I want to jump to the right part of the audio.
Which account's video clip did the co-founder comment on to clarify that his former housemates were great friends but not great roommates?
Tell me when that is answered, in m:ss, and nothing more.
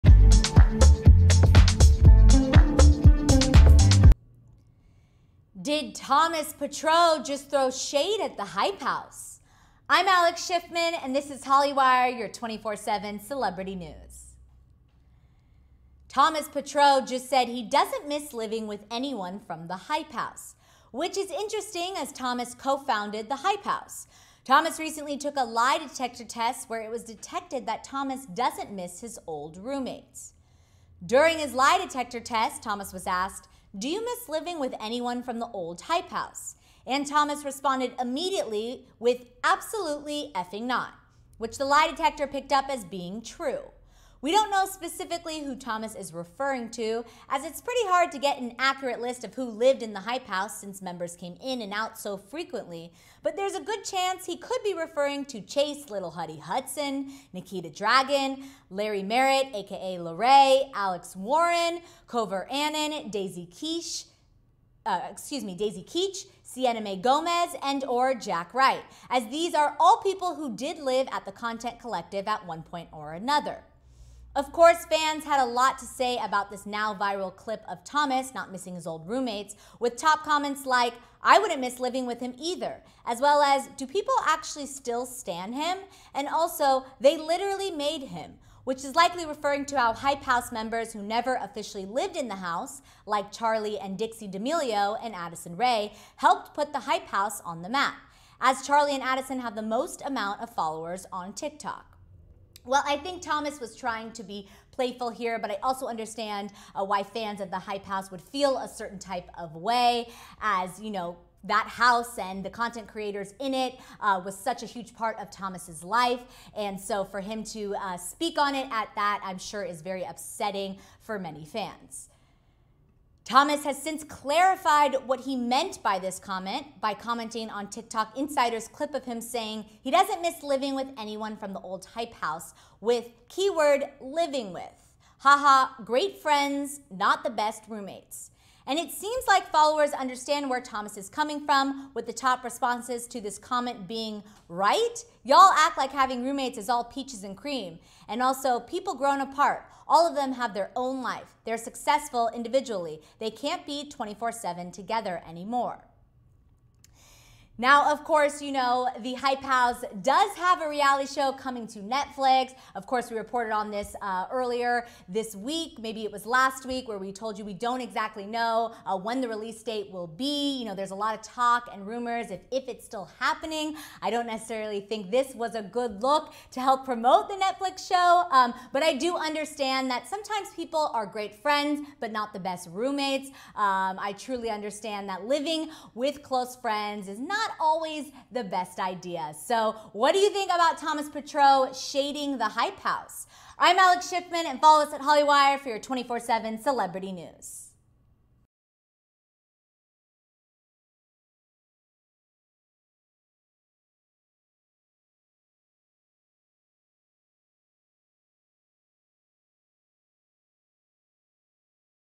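2:07.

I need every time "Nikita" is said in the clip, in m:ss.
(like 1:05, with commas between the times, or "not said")
0:57.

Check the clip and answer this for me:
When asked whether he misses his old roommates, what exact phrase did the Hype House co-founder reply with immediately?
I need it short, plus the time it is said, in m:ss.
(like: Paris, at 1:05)
absolutely effing not, at 0:39.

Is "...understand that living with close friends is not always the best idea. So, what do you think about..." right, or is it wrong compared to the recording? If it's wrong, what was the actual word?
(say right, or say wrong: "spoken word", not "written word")
right.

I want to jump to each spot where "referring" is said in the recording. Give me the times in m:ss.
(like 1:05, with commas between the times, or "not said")
0:46, 0:54, 1:29.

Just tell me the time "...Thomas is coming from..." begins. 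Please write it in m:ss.
2:20.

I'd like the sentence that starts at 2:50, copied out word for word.
You know, there's a lot of talk and rumors if, if it's still happening.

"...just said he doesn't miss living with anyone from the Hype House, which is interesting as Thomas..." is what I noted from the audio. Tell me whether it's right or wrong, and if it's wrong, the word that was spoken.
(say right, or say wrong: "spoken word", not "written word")
right.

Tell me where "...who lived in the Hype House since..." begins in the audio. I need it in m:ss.
0:49.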